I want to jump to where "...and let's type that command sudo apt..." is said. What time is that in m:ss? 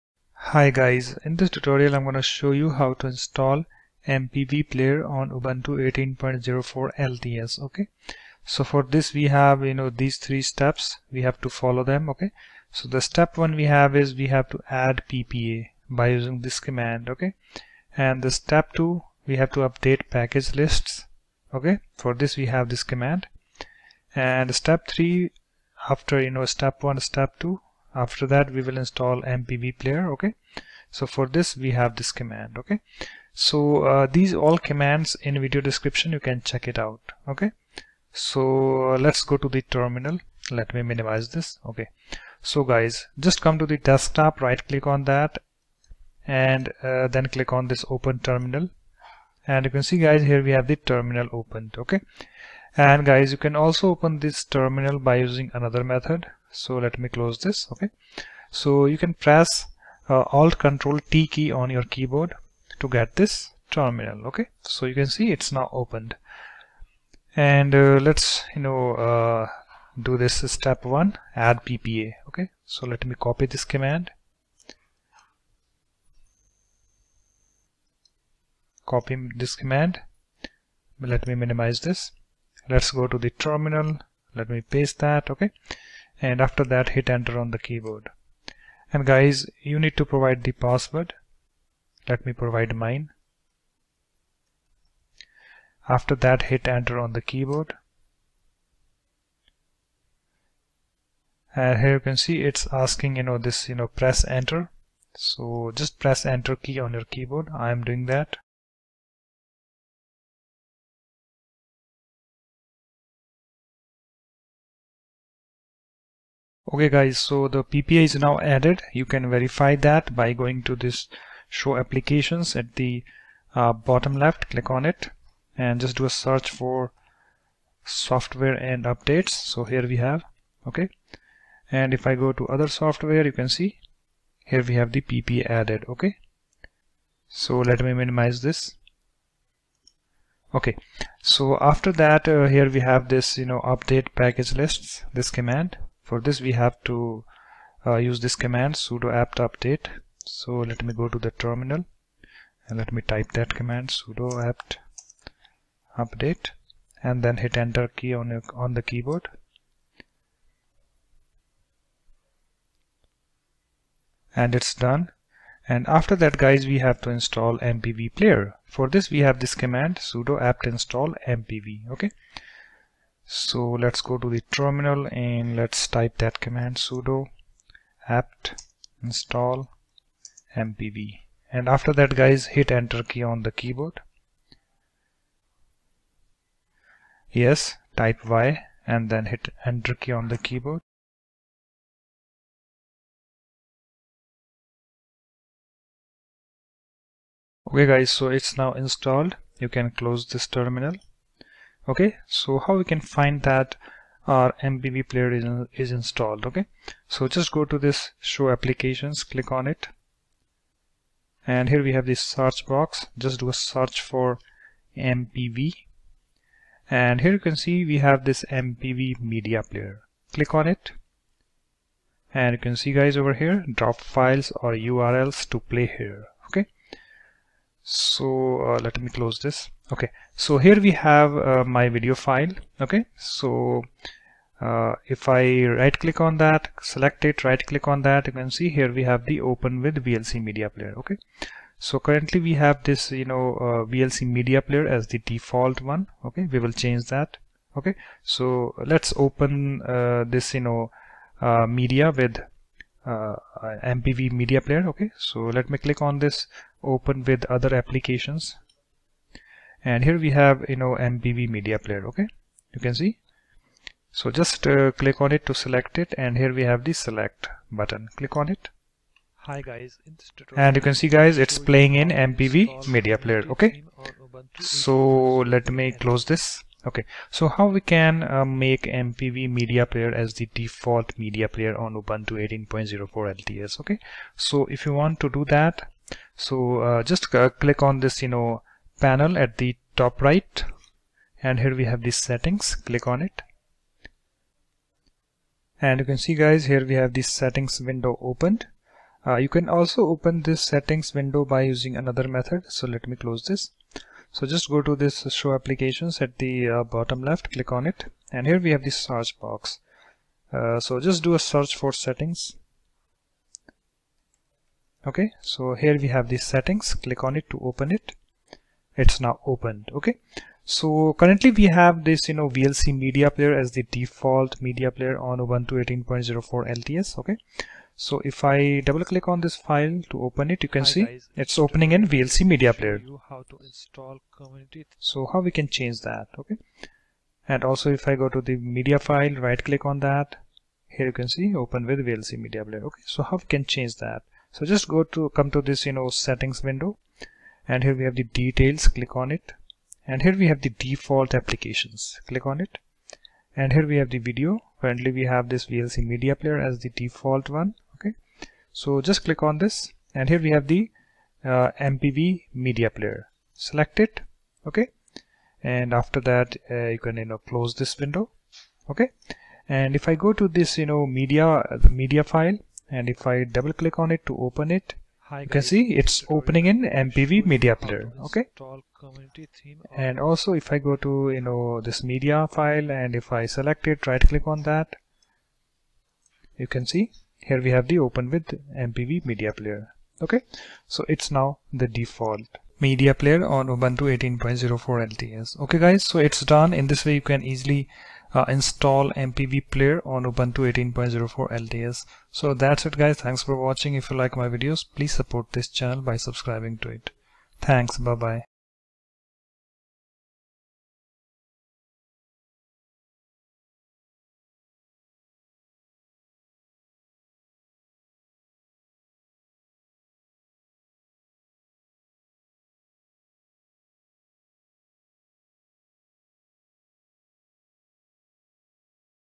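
2:55.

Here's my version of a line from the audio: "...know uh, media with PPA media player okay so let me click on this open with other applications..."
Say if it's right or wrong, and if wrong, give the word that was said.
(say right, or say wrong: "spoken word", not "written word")
wrong: "MPV", not "PPA".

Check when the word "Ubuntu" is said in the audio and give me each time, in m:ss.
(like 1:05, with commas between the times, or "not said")
0:05, 4:41, 5:25, 6:33, 6:40.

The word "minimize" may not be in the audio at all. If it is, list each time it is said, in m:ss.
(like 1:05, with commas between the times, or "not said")
0:40, 1:21, 2:17.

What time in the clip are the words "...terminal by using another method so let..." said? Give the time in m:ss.
0:54.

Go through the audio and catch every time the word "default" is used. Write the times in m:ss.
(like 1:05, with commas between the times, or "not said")
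4:05, 4:40, 5:23, 5:50, 5:56, 6:31.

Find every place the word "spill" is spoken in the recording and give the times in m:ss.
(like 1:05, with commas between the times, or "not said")
not said.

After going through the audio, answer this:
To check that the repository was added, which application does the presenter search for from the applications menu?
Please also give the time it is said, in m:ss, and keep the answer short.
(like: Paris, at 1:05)
Software and Updates, at 2:07.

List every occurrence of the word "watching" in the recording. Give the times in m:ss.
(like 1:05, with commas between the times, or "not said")
6:43.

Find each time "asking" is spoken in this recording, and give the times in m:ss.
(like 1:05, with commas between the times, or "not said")
1:42.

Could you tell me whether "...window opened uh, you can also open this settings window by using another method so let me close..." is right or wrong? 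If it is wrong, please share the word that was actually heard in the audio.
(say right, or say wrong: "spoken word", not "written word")
right.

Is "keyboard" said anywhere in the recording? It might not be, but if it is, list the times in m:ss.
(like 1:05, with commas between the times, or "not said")
1:01, 1:27, 1:37, 1:47, 2:38, 3:03, 3:10.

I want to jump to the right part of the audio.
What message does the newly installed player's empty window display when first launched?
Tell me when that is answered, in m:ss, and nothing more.
3:43.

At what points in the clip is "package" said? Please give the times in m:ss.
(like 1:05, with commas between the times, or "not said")
0:20, 2:24.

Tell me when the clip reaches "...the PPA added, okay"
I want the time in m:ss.
2:14.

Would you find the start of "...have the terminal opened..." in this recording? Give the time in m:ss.
0:50.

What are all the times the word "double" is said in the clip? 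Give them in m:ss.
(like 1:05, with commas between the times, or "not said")
5:28, 6:13.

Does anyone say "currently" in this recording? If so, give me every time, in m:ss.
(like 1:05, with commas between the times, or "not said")
4:01, 5:21, 5:54.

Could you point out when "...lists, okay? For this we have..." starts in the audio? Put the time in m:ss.
0:20.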